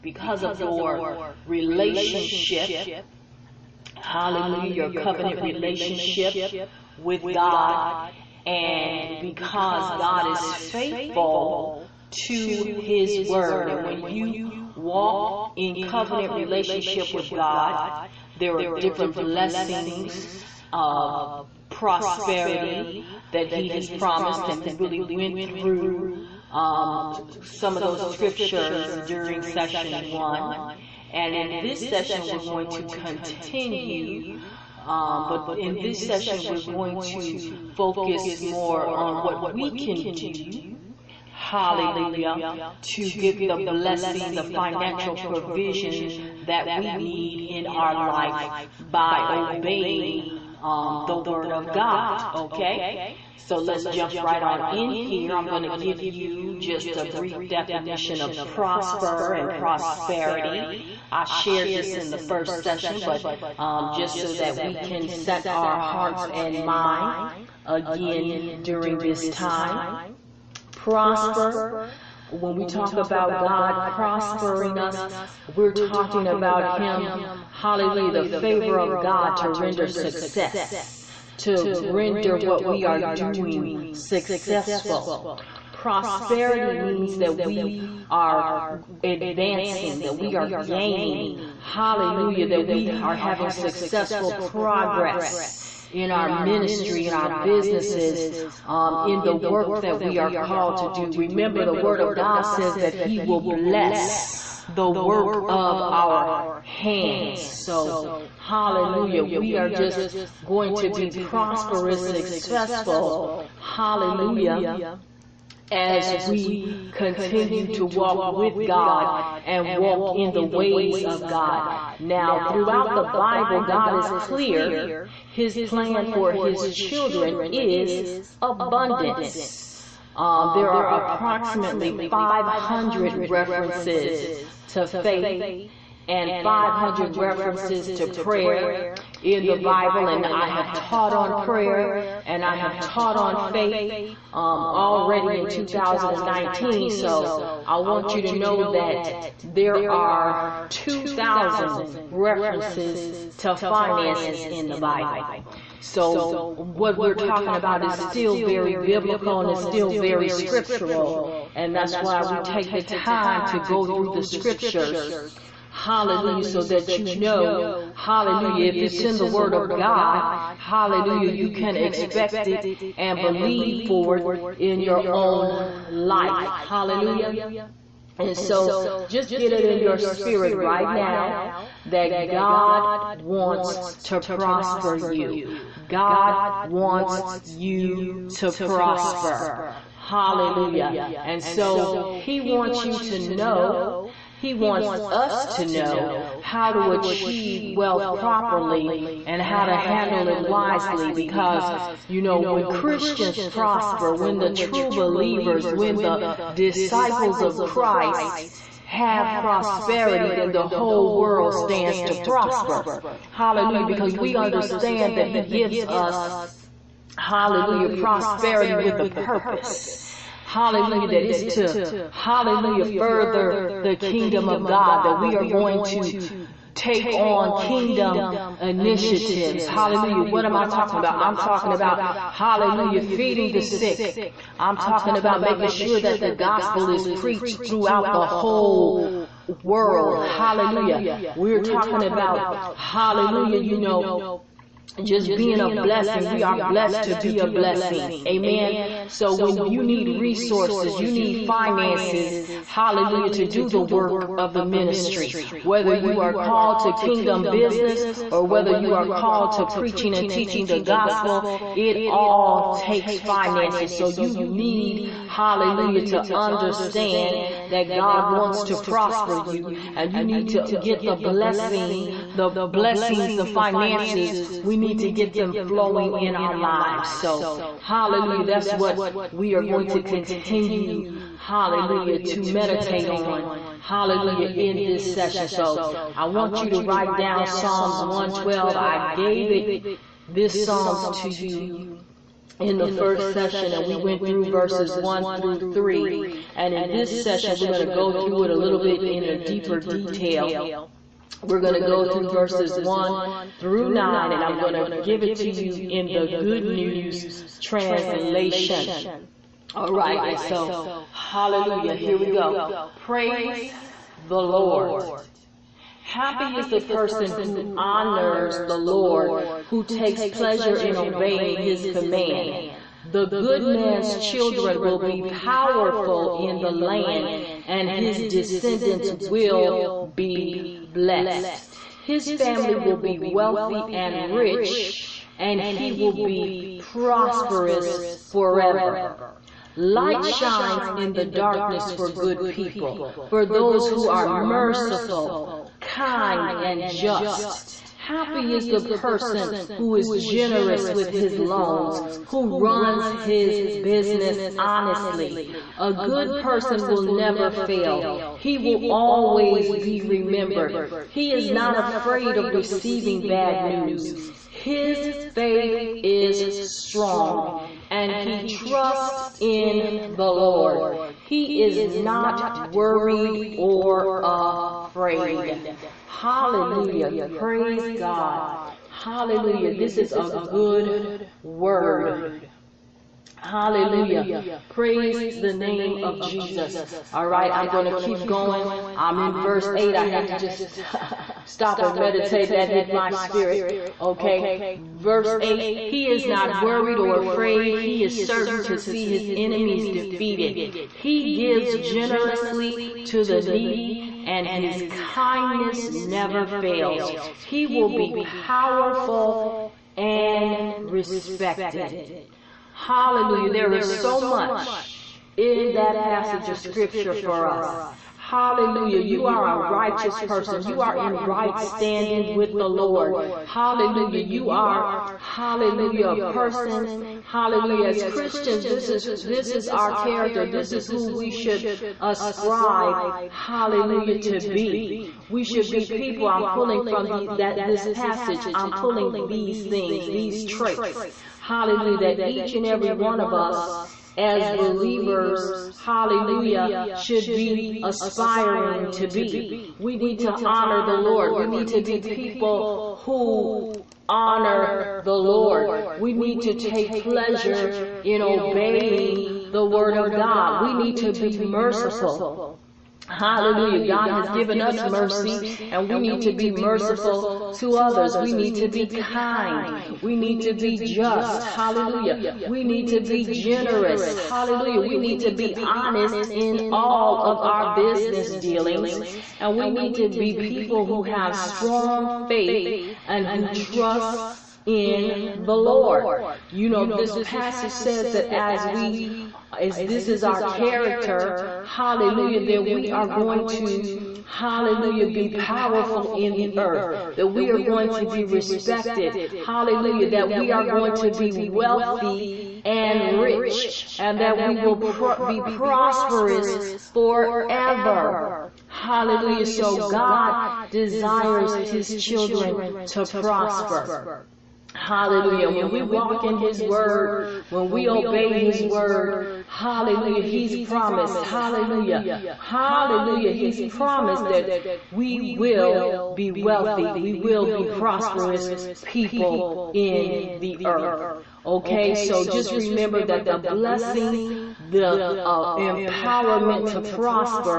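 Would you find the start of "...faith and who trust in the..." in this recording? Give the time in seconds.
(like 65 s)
482 s.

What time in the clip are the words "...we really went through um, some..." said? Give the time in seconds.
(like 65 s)
24 s.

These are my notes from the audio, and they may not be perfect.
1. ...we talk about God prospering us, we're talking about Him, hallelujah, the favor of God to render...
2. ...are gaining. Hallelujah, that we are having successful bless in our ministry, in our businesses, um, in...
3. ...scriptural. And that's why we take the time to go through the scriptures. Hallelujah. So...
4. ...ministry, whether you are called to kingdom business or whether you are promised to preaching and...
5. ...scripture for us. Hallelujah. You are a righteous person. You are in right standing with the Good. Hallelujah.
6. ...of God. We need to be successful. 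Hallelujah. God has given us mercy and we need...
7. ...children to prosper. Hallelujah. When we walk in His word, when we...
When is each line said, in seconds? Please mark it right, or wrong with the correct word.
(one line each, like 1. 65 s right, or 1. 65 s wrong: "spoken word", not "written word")
1. 72 s right
2. 90 s wrong: "progress", not "bless"
3. 160 s right
4. 254 s wrong: "called", not "promised"
5. 416 s wrong: "Lord", not "Good"
6. 459 s wrong: "merciful", not "successful"
7. 511 s right.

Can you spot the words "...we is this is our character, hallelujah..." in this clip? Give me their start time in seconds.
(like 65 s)
488 s.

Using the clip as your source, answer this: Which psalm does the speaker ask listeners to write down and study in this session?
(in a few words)
Psalms 112.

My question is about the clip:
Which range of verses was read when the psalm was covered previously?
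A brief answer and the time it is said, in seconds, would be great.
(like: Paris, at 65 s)
1 through 3, at 294 s.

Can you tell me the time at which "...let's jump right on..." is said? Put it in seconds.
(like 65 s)
53 s.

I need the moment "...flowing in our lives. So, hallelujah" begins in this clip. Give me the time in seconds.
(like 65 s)
275 s.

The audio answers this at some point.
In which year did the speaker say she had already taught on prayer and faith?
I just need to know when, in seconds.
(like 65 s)
145 s.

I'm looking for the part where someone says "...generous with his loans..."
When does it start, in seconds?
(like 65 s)
350 s.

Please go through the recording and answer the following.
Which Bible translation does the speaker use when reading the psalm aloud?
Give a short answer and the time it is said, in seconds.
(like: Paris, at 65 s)
Good News Translation, at 306 s.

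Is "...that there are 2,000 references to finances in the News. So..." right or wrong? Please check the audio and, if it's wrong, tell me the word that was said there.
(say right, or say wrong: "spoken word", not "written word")
wrong: "Bible", not "News".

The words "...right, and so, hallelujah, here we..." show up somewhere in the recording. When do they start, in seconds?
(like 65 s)
309 s.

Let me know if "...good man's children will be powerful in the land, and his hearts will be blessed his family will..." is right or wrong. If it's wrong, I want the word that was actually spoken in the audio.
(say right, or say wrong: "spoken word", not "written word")
wrong: "descendants", not "hearts".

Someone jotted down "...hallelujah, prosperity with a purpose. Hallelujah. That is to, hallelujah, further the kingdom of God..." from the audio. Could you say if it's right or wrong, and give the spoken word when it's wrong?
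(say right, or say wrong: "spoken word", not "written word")
right.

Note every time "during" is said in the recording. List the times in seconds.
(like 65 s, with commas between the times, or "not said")
28 s, 68 s.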